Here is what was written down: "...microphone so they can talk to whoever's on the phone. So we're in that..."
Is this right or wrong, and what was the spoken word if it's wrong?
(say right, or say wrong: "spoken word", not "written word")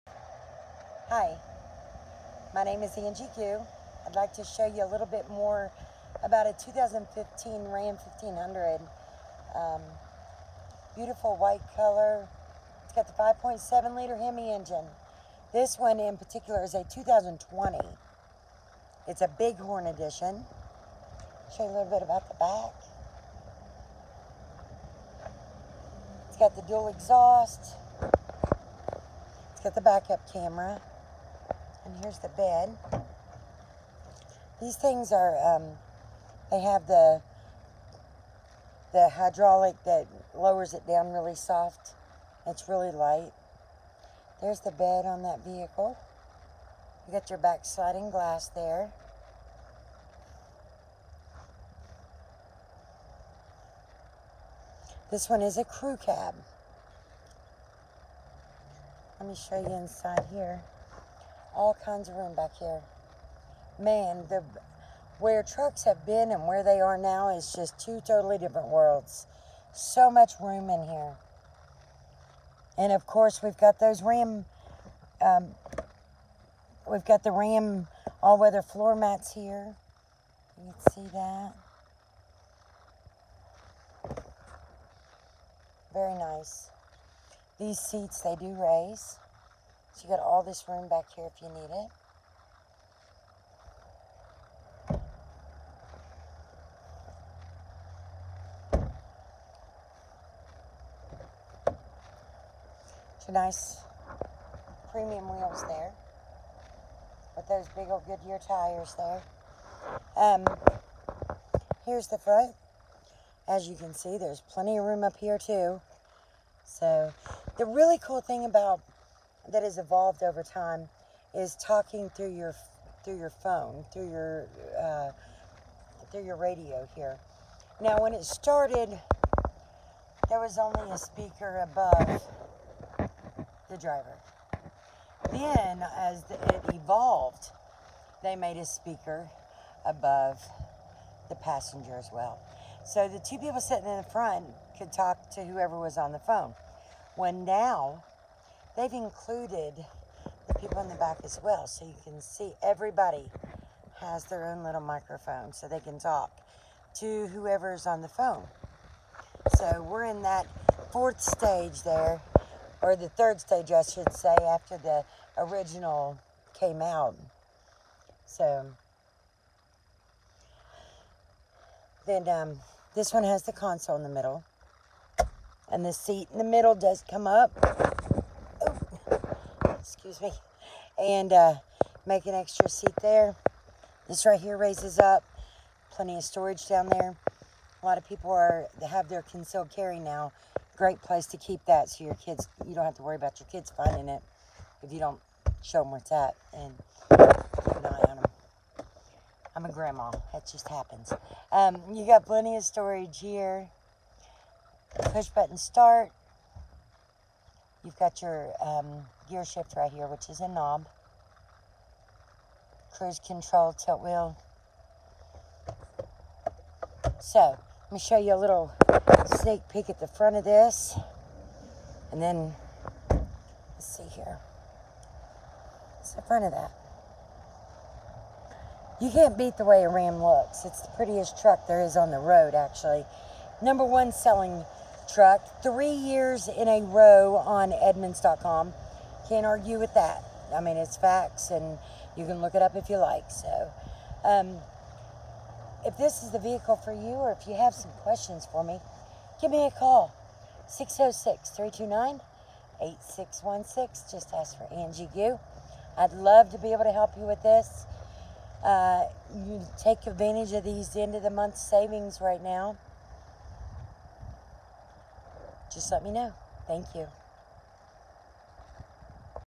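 right.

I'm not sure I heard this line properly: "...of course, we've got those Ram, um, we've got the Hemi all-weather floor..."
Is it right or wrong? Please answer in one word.
wrong.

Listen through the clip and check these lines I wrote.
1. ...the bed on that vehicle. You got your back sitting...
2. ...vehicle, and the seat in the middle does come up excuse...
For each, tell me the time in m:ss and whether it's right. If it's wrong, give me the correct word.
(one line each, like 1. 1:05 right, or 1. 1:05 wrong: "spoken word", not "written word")
1. 0:44 wrong: "sliding", not "sitting"
2. 2:54 wrong: "middle", not "vehicle".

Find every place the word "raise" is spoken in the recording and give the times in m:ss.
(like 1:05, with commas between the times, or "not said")
1:28, 3:04.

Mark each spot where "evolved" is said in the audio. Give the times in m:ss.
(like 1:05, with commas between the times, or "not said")
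1:59, 2:16.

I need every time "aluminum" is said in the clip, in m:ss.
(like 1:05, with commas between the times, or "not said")
not said.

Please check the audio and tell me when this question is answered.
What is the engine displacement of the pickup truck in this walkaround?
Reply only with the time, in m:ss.
0:13.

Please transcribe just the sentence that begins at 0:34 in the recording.
These things are, um, they have the, the hydraulic that lowers it down really soft.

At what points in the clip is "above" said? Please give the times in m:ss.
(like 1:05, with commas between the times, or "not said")
2:11, 2:19.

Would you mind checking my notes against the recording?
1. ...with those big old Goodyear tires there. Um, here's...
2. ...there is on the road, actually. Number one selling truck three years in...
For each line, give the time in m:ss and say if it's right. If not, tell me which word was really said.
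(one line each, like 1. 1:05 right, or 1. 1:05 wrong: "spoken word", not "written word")
1. 1:47 right
2. 3:51 right.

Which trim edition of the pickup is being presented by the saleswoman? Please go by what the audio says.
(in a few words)
Bighorn.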